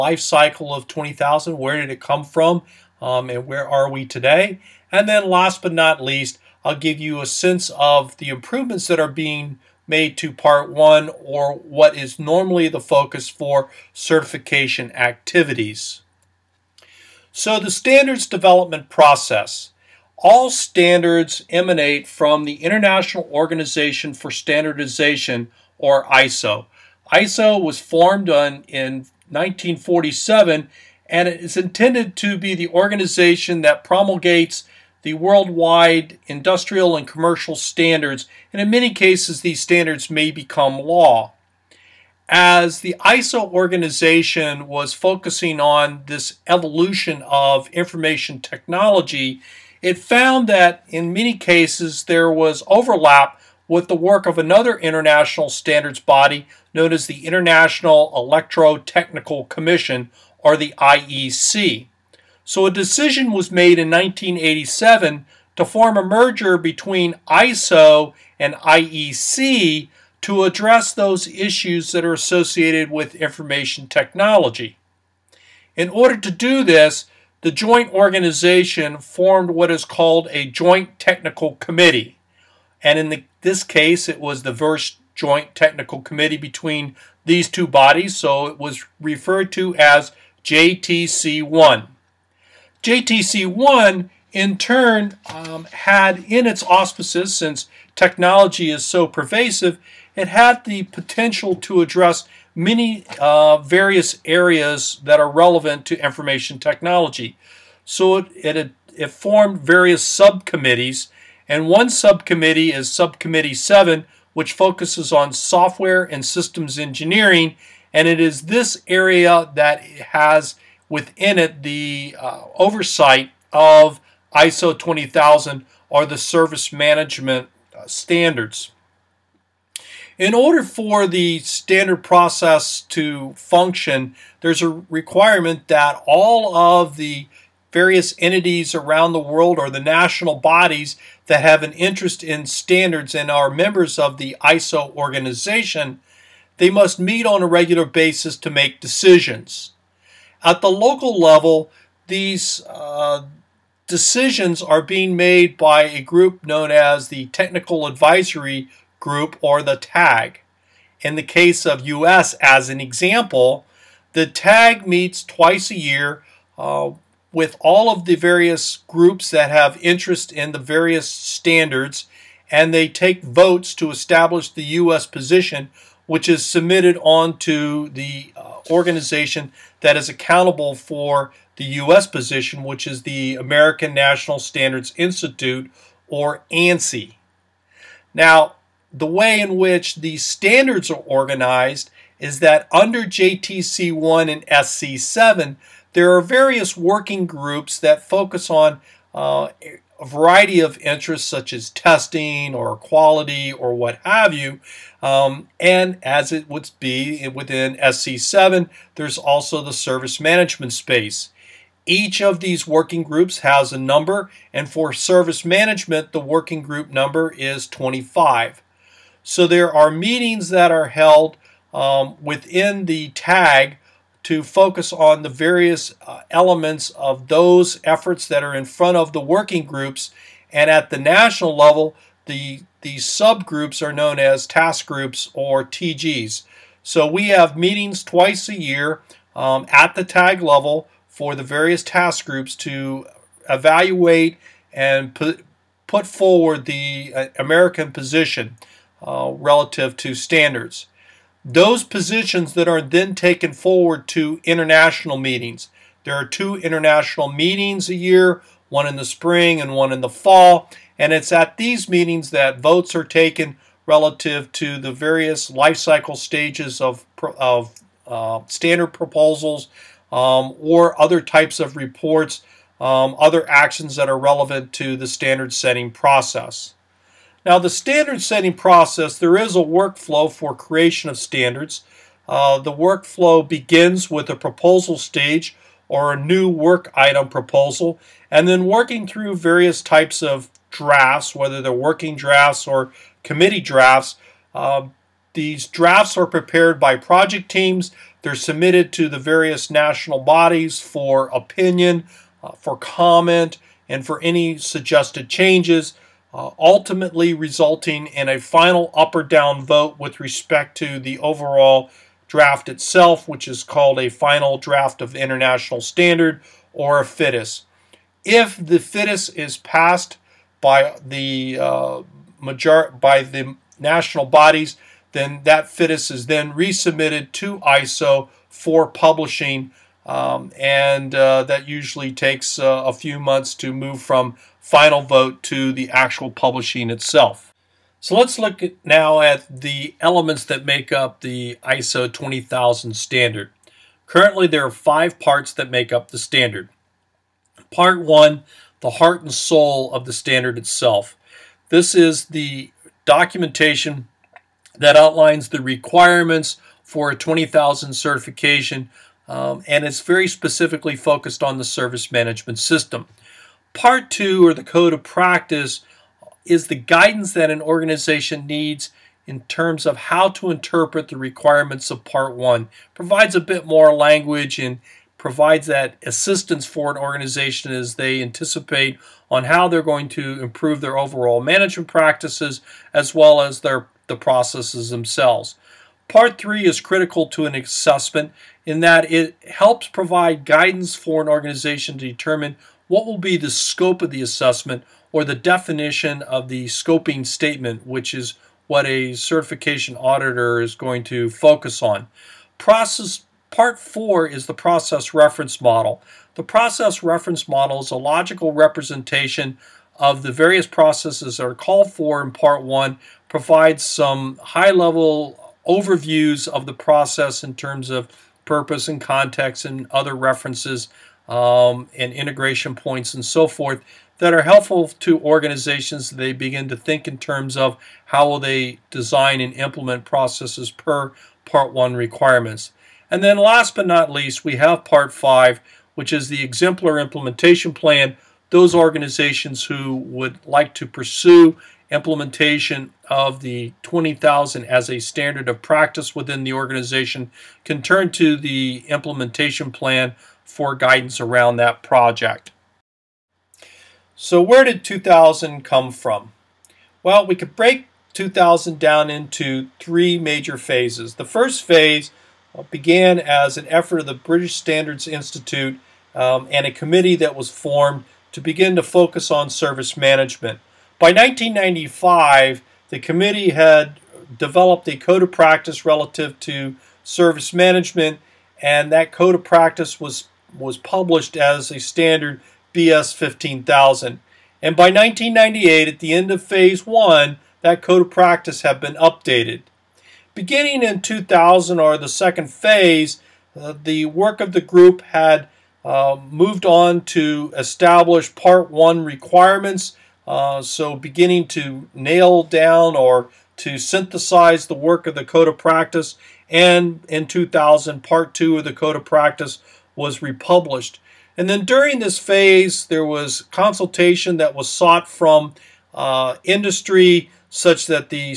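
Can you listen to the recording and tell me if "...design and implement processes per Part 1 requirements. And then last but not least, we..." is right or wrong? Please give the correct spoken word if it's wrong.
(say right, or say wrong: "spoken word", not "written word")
right.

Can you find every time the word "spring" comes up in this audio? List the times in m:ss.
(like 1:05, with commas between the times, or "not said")
4:19.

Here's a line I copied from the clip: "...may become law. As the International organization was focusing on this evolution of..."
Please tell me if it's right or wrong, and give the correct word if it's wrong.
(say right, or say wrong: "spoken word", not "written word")
wrong: "ISO", not "International".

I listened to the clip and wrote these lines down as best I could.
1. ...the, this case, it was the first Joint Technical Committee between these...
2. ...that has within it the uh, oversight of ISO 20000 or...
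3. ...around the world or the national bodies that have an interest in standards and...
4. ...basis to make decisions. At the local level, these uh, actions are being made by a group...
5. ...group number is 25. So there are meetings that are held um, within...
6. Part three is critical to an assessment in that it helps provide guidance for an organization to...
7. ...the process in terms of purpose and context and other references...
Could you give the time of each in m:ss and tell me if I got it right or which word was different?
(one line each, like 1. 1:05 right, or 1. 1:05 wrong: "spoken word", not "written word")
1. 1:23 right
2. 1:59 right
3. 2:18 right
4. 2:27 wrong: "decisions", not "actions"
5. 3:36 right
6. 6:26 right
7. 6:56 right.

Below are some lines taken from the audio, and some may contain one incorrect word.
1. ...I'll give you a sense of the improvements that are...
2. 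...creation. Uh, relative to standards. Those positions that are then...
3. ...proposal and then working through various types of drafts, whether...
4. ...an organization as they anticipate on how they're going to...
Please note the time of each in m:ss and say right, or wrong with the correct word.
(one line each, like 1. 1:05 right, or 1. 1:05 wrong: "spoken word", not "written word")
1. 0:06 right
2. 4:07 wrong: "position", not "creation"
3. 4:47 right
4. 6:16 right.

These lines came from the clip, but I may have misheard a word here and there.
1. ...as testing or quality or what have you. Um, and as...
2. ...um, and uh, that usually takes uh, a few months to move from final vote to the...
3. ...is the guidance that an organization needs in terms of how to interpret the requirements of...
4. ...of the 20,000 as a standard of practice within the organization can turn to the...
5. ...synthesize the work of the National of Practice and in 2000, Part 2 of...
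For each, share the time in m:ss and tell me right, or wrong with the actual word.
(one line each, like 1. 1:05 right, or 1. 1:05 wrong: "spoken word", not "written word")
1. 3:21 right
2. 5:30 right
3. 6:06 right
4. 7:23 right
5. 8:23 wrong: "Code", not "National".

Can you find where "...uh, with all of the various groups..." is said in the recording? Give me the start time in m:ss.
2:46.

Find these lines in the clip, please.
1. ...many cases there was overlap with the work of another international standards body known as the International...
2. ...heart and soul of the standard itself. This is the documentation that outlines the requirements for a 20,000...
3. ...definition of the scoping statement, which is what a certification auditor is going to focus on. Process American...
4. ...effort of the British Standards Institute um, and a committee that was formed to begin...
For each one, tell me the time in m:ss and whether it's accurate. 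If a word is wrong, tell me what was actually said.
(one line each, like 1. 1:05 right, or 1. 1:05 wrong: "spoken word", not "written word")
1. 0:51 right
2. 5:48 right
3. 6:35 wrong: "Part", not "American"
4. 7:43 right.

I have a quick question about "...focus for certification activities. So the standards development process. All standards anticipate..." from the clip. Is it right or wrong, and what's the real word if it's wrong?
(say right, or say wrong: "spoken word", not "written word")
wrong: "emanate", not "anticipate".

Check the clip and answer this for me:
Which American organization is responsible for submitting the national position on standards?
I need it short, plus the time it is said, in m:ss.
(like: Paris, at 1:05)
American National Standards Institute, at 3:03.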